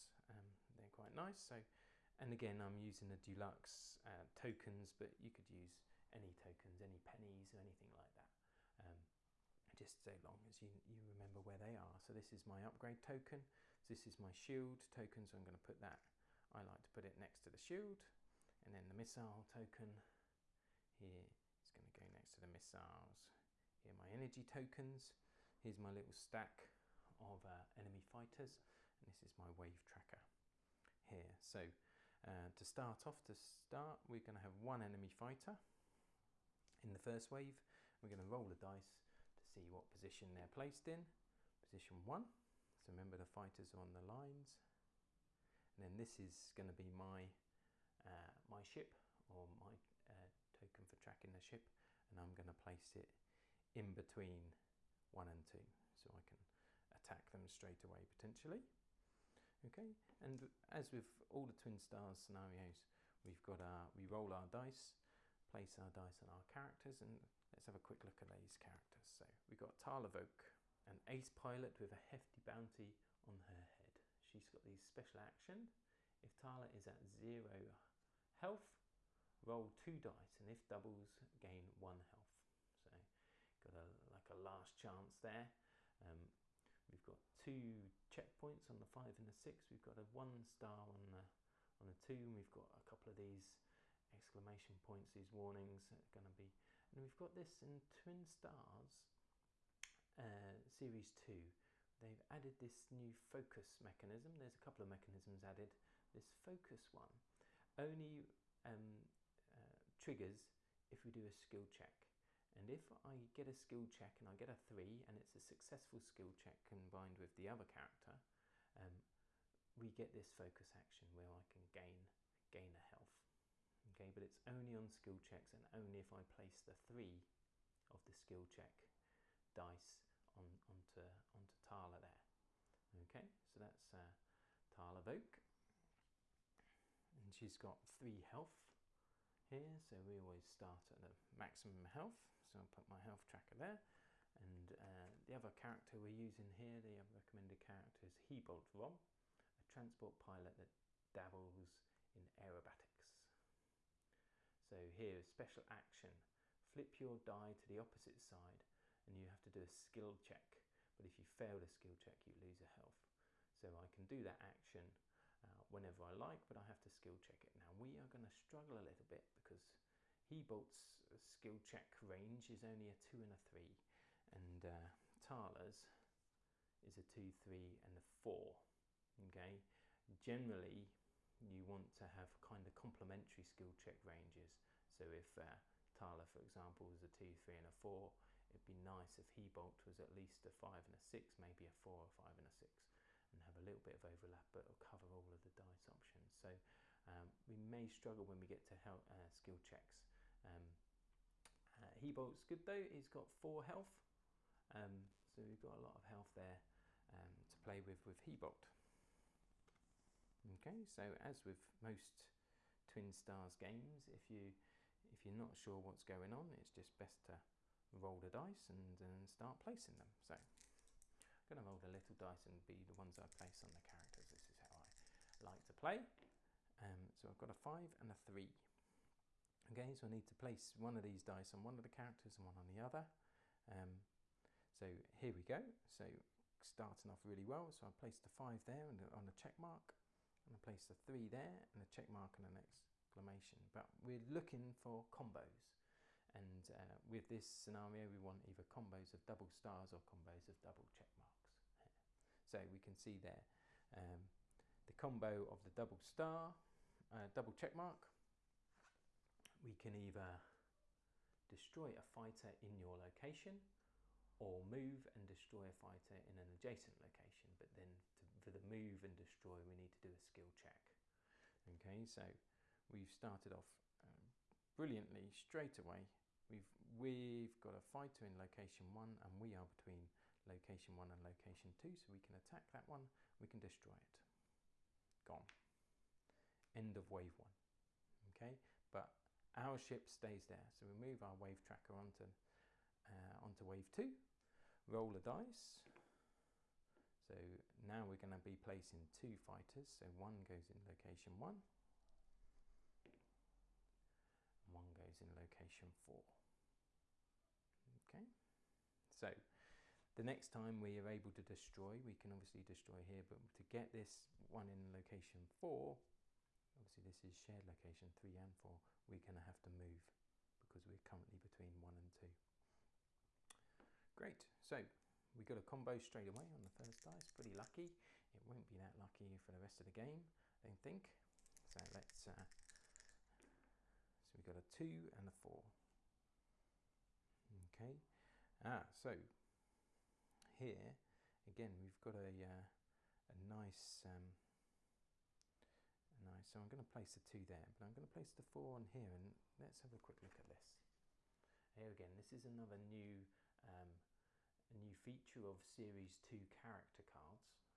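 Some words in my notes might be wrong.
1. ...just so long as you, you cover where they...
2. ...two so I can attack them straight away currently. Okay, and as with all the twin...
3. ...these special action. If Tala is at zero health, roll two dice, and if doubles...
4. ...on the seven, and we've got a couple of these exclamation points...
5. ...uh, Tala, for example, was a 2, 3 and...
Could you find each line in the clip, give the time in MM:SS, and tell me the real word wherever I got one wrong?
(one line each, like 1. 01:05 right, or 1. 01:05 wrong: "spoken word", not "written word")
1. 00:09 wrong: "remember", not "cover"
2. 00:55 wrong: "potentially", not "currently"
3. 01:14 right
4. 01:31 wrong: "two", not "seven"
5. 03:05 right.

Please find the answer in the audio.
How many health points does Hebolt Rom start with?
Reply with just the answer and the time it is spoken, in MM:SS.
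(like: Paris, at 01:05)
4, at 03:23.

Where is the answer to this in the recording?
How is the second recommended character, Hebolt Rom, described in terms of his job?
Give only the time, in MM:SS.
02:29.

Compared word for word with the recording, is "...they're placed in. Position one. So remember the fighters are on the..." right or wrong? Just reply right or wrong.
right.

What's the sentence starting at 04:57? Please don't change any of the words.
So now we're gonna be placing two fighters.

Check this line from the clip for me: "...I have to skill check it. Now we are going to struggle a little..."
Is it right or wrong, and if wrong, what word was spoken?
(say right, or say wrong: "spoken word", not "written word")
right.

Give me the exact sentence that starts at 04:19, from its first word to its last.
We can either destroy a fighter in your location or move and destroy a fighter in an adjacent location.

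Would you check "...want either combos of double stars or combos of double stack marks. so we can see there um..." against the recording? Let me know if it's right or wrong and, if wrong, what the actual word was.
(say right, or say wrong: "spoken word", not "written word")
wrong: "check", not "stack".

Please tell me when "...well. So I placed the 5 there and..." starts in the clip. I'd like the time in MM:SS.
03:57.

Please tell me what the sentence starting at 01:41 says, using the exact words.
They've added this new focus mechanism.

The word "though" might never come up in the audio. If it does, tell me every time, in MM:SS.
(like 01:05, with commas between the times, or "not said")
03:22.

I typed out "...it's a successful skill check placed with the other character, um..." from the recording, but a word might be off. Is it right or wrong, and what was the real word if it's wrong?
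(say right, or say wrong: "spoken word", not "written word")
wrong: "combined", not "placed".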